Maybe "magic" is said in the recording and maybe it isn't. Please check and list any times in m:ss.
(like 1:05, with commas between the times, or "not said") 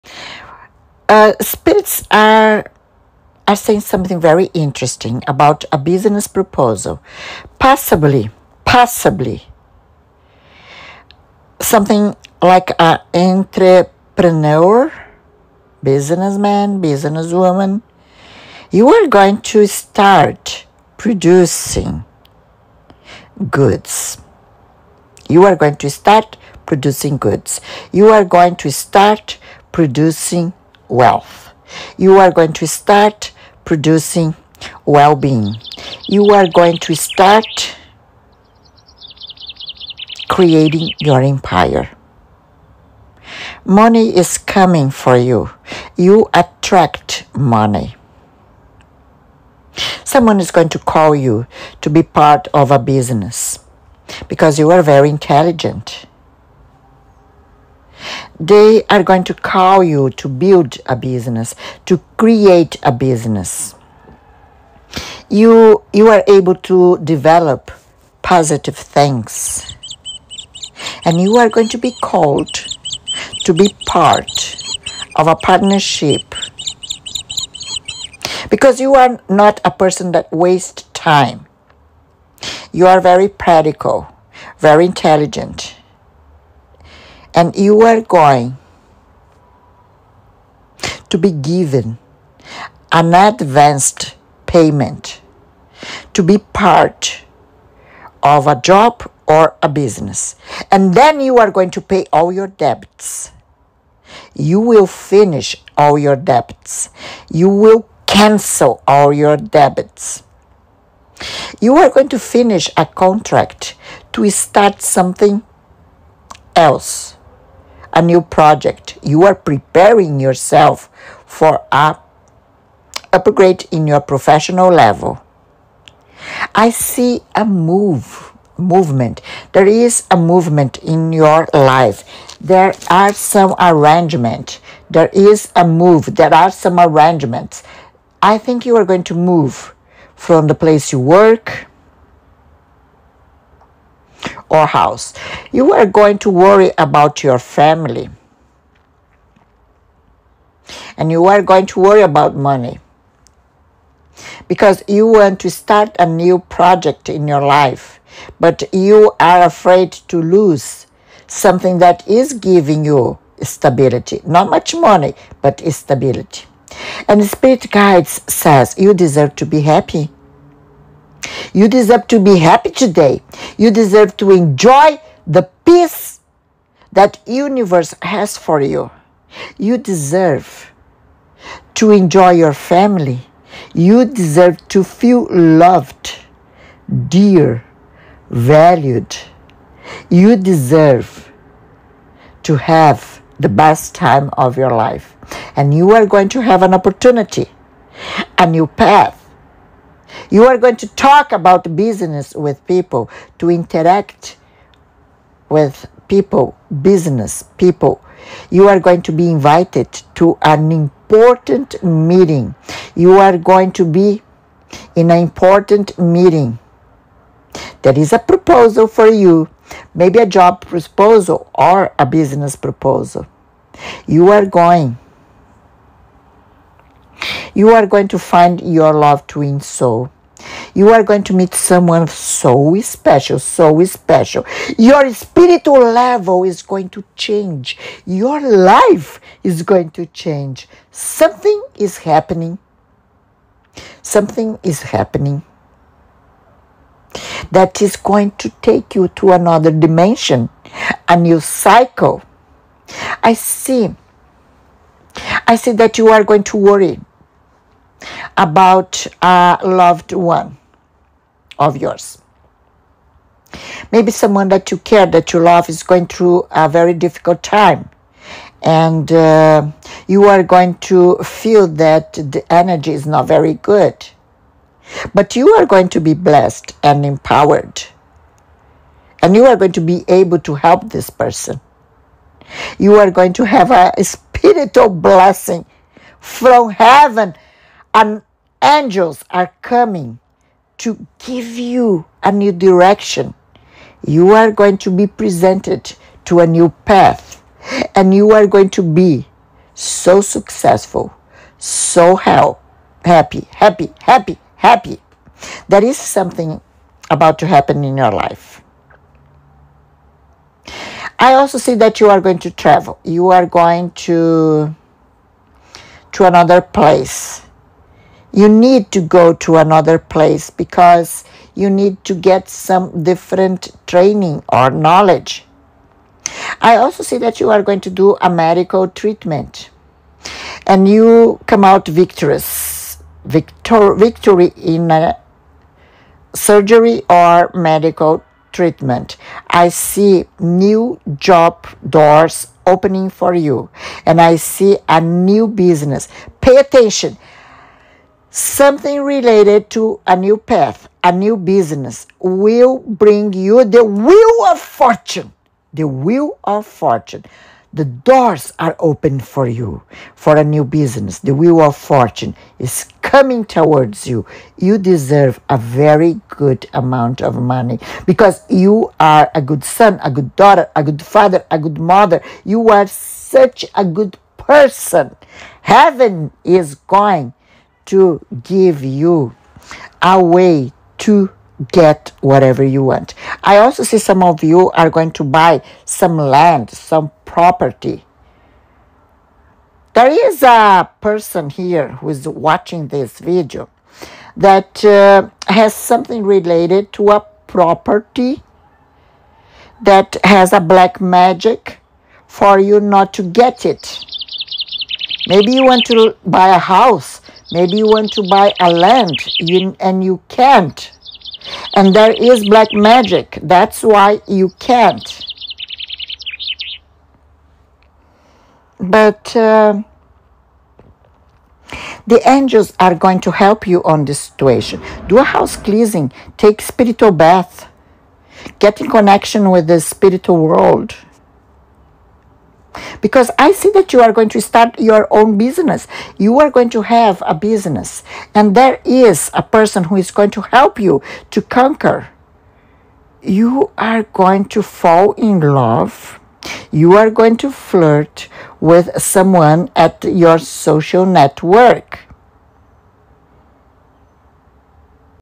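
6:41, 6:52.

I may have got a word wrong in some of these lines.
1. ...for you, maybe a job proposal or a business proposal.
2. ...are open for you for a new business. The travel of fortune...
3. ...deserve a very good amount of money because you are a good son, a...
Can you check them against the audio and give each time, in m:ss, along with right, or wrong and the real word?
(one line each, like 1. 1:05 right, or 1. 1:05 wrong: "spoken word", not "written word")
1. 3:38 right
2. 5:58 wrong: "wheel", not "travel"
3. 6:04 right.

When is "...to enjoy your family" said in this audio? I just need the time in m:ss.
3:01.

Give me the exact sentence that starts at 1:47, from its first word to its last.
You will cancel all your debts.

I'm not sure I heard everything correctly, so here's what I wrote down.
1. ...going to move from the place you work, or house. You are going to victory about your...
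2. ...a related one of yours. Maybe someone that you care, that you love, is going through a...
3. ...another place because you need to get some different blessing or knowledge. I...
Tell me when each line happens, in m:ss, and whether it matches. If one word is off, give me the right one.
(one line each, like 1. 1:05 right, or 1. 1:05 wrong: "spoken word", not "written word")
1. 2:18 wrong: "worry", not "victory"
2. 4:19 wrong: "loved", not "related"
3. 5:19 wrong: "training", not "blessing".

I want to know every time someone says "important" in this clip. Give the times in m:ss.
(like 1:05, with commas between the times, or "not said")
3:30, 3:35.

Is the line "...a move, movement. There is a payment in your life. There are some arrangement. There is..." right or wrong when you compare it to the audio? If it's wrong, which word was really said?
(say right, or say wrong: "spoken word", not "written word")
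wrong: "movement", not "payment".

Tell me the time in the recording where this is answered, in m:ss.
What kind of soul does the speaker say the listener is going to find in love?
3:49.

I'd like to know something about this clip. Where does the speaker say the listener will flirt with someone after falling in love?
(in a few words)
social network.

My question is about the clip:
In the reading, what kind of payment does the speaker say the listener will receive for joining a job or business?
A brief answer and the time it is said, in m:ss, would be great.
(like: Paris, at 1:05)
advanced payment, at 1:33.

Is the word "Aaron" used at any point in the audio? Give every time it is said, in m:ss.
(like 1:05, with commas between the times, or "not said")
not said.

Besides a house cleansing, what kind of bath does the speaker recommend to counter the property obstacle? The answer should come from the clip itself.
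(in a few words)
spiritual bath.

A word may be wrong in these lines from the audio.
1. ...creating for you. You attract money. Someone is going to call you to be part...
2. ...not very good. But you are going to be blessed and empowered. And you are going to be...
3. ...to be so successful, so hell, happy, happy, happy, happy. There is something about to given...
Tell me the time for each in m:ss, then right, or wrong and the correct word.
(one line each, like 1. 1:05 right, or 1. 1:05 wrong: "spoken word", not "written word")
1. 0:44 wrong: "coming", not "creating"
2. 4:33 right
3. 4:58 wrong: "happen", not "given".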